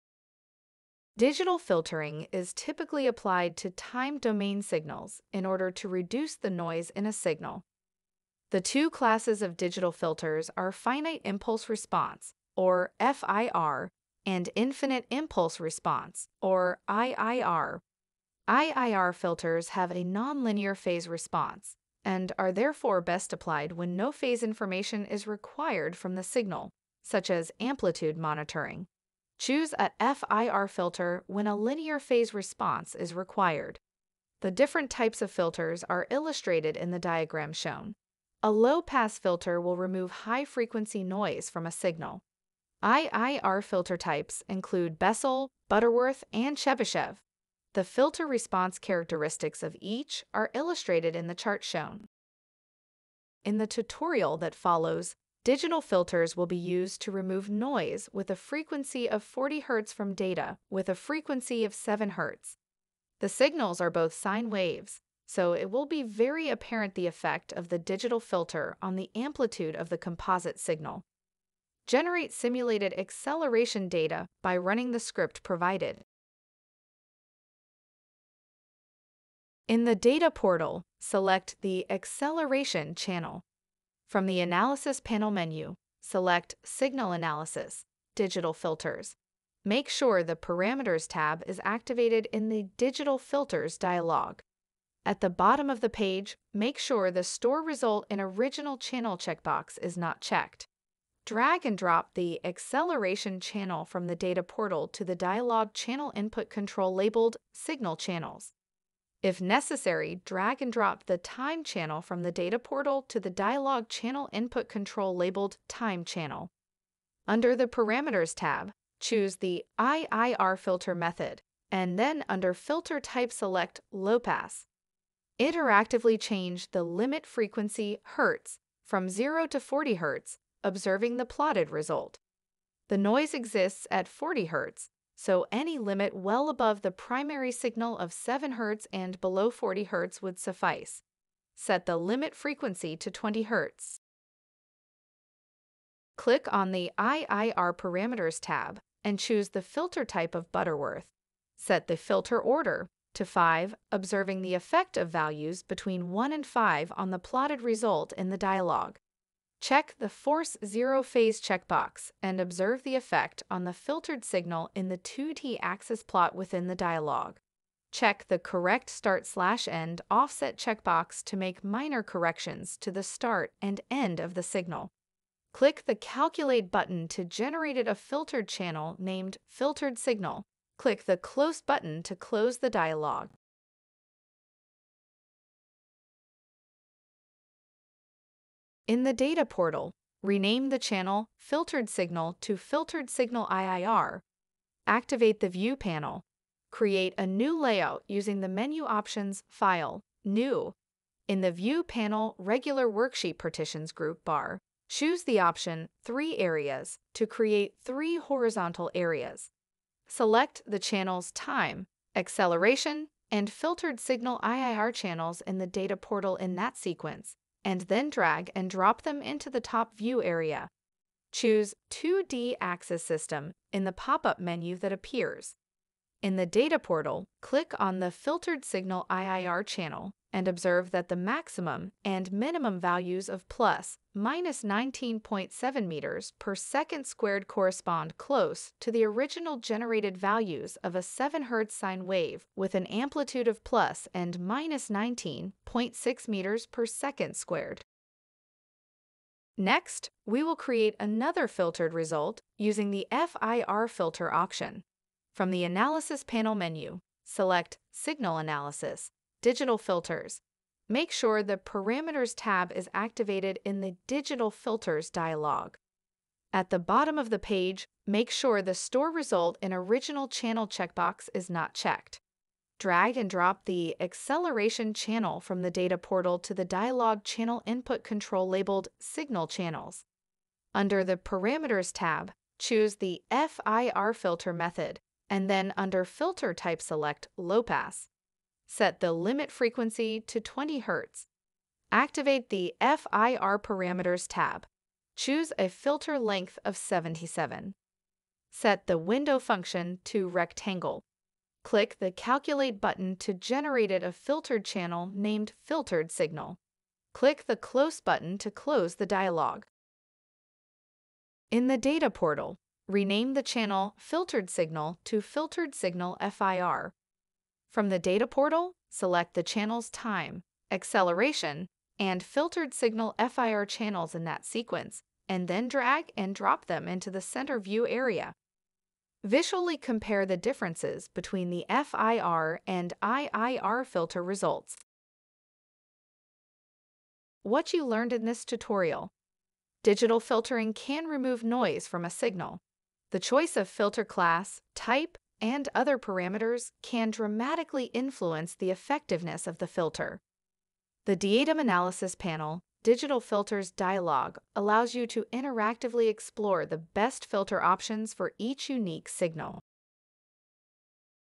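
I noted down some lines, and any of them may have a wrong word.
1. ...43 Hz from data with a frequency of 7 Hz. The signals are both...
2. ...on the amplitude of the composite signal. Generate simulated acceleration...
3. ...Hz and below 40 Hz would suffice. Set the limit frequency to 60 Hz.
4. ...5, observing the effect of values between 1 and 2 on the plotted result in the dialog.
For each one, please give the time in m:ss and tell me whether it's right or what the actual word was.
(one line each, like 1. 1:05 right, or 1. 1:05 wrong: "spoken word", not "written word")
1. 0:59 wrong: "40", not "43"
2. 1:08 right
3. 2:18 wrong: "20", not "60"
4. 2:33 wrong: "5", not "2".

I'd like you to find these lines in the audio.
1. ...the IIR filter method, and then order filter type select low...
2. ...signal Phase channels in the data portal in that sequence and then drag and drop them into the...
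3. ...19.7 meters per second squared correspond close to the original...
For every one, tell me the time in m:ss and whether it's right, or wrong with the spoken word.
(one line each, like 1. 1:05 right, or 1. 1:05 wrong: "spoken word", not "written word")
1. 1:59 wrong: "under", not "order"
2. 3:34 wrong: "IIR", not "Phase"
3. 3:54 right.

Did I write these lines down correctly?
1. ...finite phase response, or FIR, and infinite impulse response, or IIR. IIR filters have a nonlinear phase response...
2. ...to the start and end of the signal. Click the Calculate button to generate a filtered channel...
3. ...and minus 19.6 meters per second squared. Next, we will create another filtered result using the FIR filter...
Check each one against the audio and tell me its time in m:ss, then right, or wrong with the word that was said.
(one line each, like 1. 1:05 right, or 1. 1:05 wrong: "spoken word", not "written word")
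1. 0:10 wrong: "impulse", not "phase"
2. 2:52 right
3. 4:04 right.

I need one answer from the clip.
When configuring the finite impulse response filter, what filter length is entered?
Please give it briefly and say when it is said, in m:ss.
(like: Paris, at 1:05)
77, at 4:56.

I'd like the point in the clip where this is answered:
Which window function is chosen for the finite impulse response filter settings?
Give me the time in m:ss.
5:00.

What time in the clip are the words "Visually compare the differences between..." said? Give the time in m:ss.
5:29.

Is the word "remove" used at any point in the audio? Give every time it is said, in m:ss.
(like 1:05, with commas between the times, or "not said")
0:39, 0:57, 5:41.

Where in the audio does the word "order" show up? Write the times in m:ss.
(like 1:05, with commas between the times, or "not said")
0:05, 2:32.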